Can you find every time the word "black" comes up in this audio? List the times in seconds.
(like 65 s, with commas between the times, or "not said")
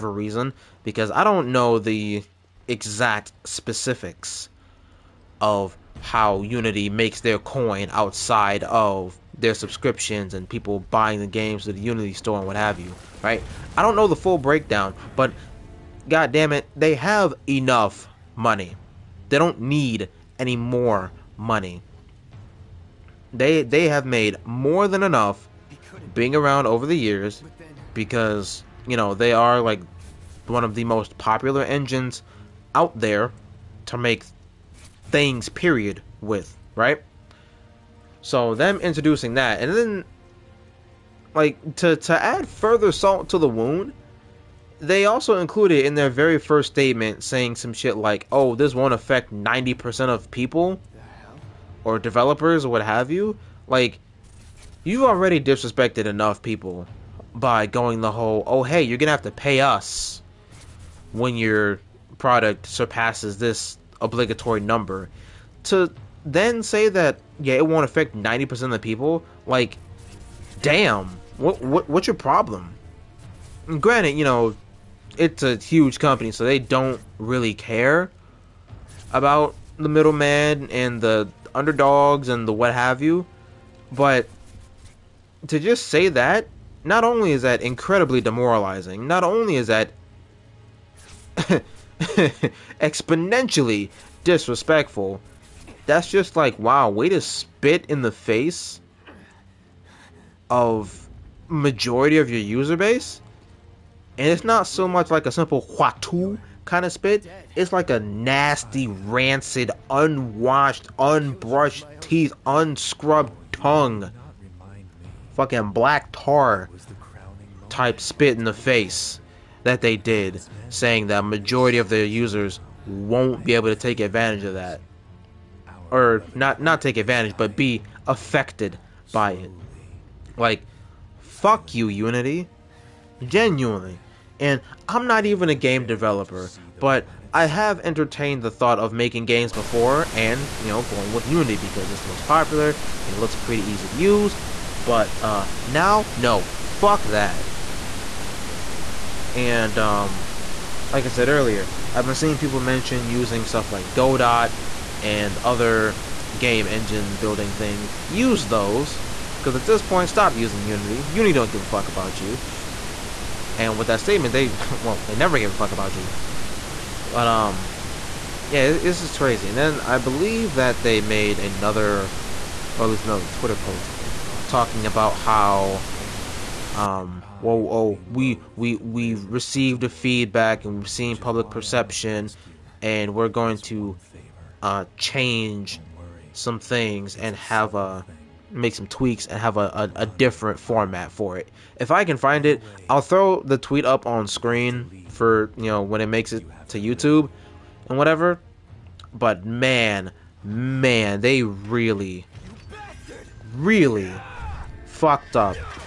115 s.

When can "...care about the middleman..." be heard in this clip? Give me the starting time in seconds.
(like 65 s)
77 s.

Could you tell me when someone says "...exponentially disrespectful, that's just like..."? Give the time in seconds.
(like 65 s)
92 s.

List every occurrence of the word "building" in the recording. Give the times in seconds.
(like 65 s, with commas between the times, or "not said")
157 s.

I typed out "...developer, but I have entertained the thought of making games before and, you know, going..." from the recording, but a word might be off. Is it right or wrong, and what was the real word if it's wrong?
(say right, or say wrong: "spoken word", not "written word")
right.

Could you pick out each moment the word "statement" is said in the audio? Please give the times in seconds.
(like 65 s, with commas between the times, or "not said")
46 s, 163 s.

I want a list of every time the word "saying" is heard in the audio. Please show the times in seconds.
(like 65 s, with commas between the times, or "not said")
47 s, 120 s.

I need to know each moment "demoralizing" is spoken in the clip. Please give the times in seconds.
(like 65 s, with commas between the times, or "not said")
88 s.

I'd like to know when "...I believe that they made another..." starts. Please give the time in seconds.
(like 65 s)
169 s.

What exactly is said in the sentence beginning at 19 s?
They don't need any more money.